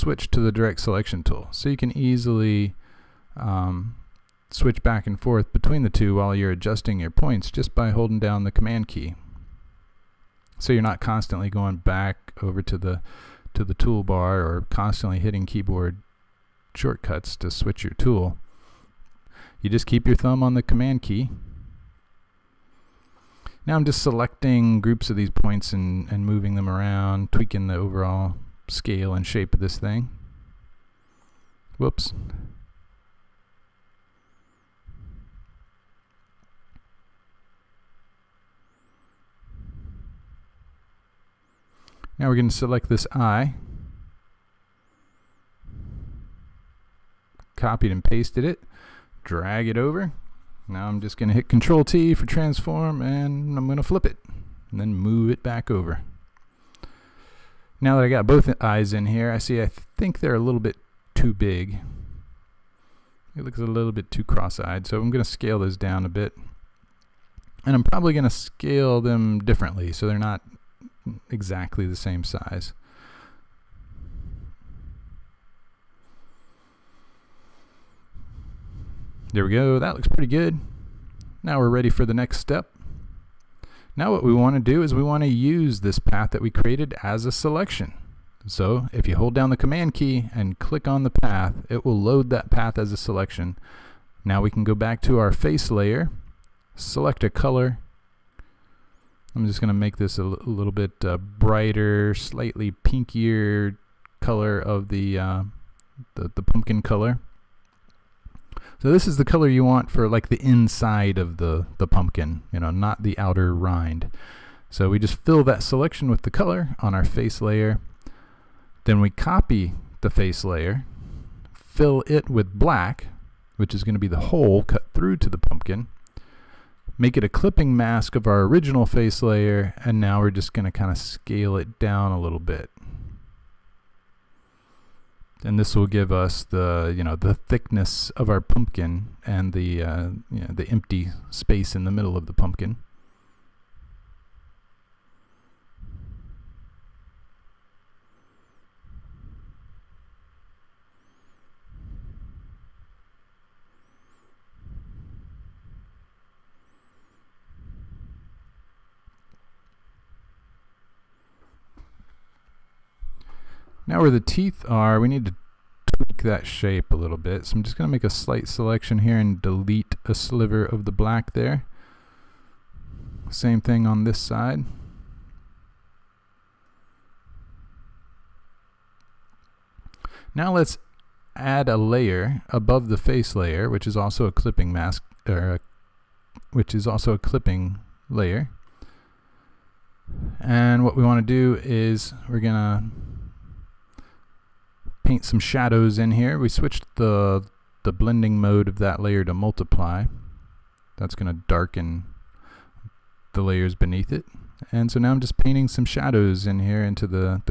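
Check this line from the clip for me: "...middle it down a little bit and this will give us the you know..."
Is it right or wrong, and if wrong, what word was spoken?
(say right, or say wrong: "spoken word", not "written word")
wrong: "scale", not "middle".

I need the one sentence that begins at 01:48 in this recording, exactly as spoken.
So this is the color you want for like the inside of the, the pumpkin, you know, not the outer rind.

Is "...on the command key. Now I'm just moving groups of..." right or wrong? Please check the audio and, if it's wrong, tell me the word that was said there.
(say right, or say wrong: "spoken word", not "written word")
wrong: "selecting", not "moving".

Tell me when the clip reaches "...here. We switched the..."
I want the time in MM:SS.
03:16.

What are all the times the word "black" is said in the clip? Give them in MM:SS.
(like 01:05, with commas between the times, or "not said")
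02:02, 02:50.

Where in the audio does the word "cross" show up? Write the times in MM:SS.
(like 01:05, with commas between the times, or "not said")
01:04.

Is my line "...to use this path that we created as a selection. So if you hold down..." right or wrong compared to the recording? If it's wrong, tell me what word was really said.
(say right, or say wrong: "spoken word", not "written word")
right.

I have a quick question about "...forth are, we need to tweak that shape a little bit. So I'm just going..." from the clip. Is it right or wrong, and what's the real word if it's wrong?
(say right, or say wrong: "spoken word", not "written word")
wrong: "teeth", not "forth".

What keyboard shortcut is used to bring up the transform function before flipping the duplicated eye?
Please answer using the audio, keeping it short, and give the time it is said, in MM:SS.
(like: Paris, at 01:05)
Control T, at 00:51.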